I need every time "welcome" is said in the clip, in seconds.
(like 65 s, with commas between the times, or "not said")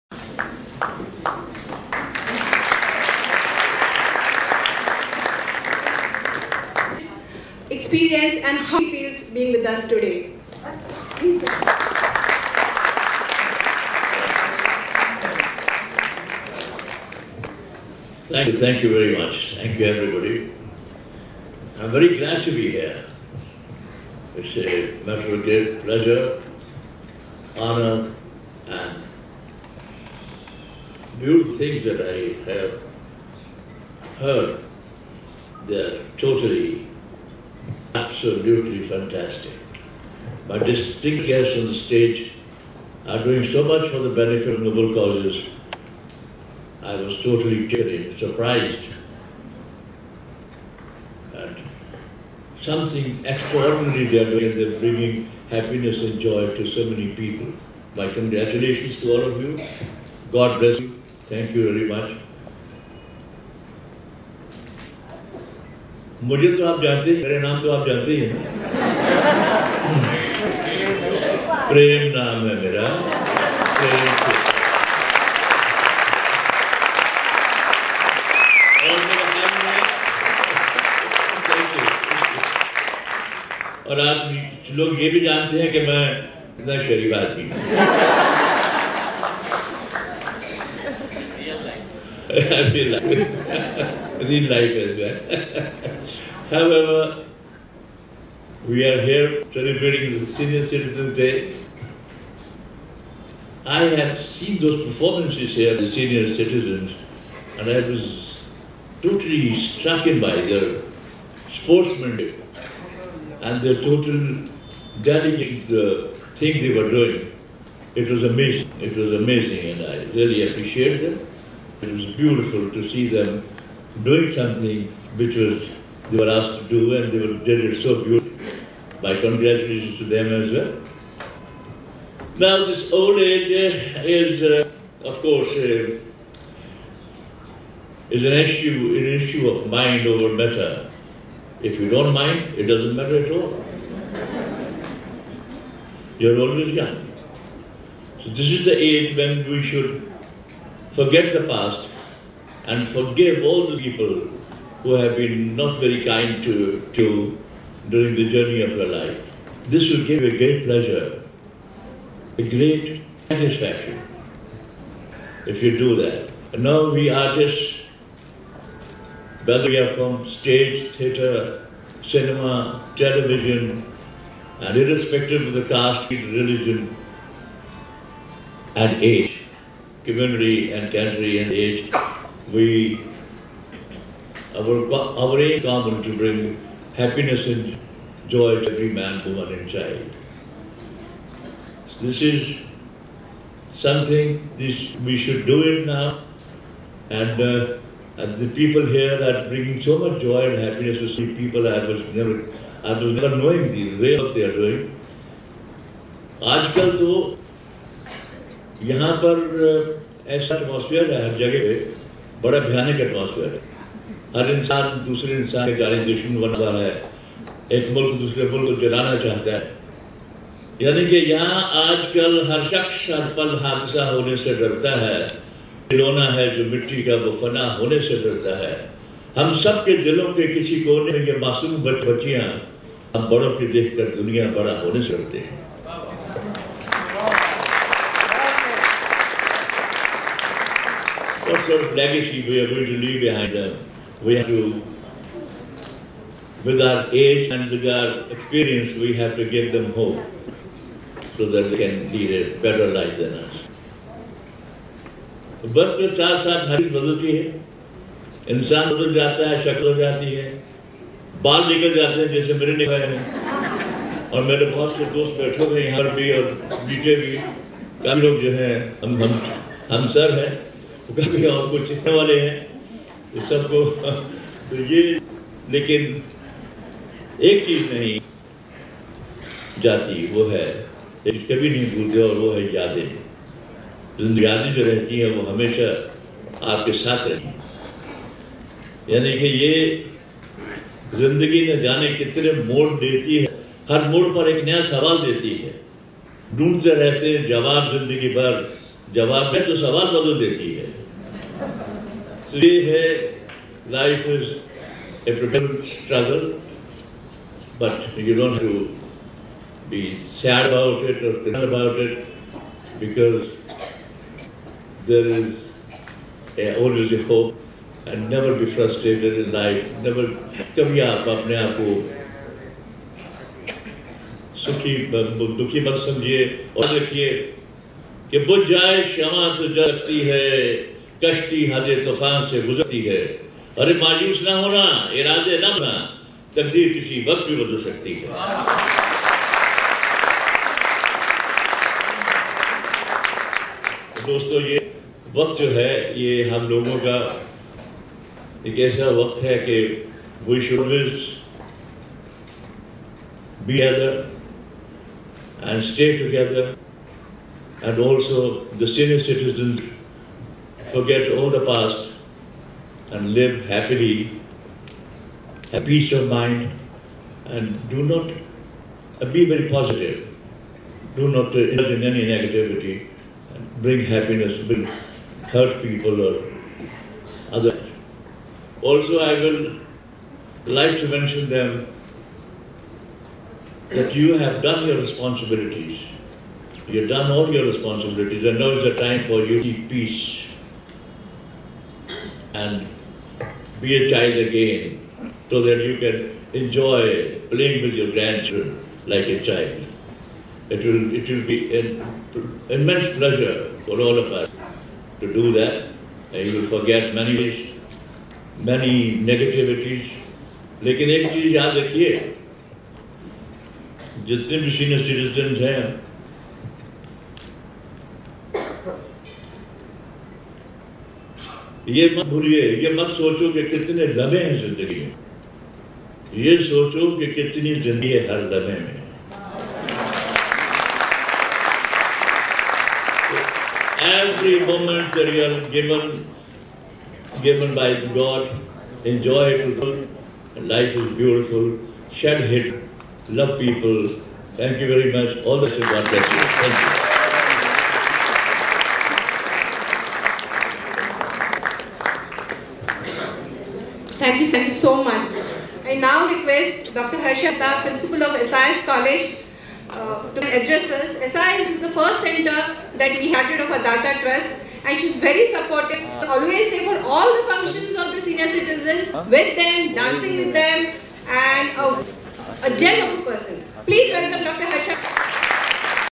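474 s.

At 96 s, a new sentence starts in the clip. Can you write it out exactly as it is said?
However, we are here celebrating the Senior Citizens Day.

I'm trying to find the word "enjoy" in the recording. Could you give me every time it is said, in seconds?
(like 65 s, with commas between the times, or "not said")
396 s, 439 s.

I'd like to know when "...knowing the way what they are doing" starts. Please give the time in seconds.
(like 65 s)
203 s.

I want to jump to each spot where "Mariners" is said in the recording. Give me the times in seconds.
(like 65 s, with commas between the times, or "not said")
not said.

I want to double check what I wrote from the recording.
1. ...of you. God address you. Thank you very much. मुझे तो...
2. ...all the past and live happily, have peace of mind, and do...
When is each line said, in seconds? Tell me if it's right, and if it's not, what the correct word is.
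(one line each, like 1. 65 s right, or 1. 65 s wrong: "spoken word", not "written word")
1. 59 s wrong: "bless", not "address"
2. 361 s right.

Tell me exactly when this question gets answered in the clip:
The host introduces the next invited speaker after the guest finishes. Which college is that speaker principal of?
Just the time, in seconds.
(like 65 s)
458 s.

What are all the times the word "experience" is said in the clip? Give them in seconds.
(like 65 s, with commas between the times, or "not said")
7 s, 248 s.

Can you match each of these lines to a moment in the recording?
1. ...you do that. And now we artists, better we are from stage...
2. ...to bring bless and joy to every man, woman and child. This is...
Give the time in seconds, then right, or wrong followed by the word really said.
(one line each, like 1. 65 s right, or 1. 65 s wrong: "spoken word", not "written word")
1. 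165 s wrong: "whether", not "better"
2. 186 s wrong: "happiness", not "bless".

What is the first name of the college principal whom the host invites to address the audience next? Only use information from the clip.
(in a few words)
Harsha.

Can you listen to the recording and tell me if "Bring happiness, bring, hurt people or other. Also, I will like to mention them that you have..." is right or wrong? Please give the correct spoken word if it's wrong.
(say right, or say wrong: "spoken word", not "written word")
right.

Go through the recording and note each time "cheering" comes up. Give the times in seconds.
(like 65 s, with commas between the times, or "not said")
47 s.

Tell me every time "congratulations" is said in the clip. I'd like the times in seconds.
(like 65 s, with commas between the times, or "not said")
58 s, 129 s.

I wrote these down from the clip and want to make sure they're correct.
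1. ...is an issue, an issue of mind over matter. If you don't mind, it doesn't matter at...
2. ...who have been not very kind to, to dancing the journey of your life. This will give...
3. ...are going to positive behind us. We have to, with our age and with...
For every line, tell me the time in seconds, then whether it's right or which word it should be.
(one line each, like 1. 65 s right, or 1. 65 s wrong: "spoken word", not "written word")
1. 138 s right
2. 154 s wrong: "during", not "dancing"
3. 242 s wrong: "leave", not "positive".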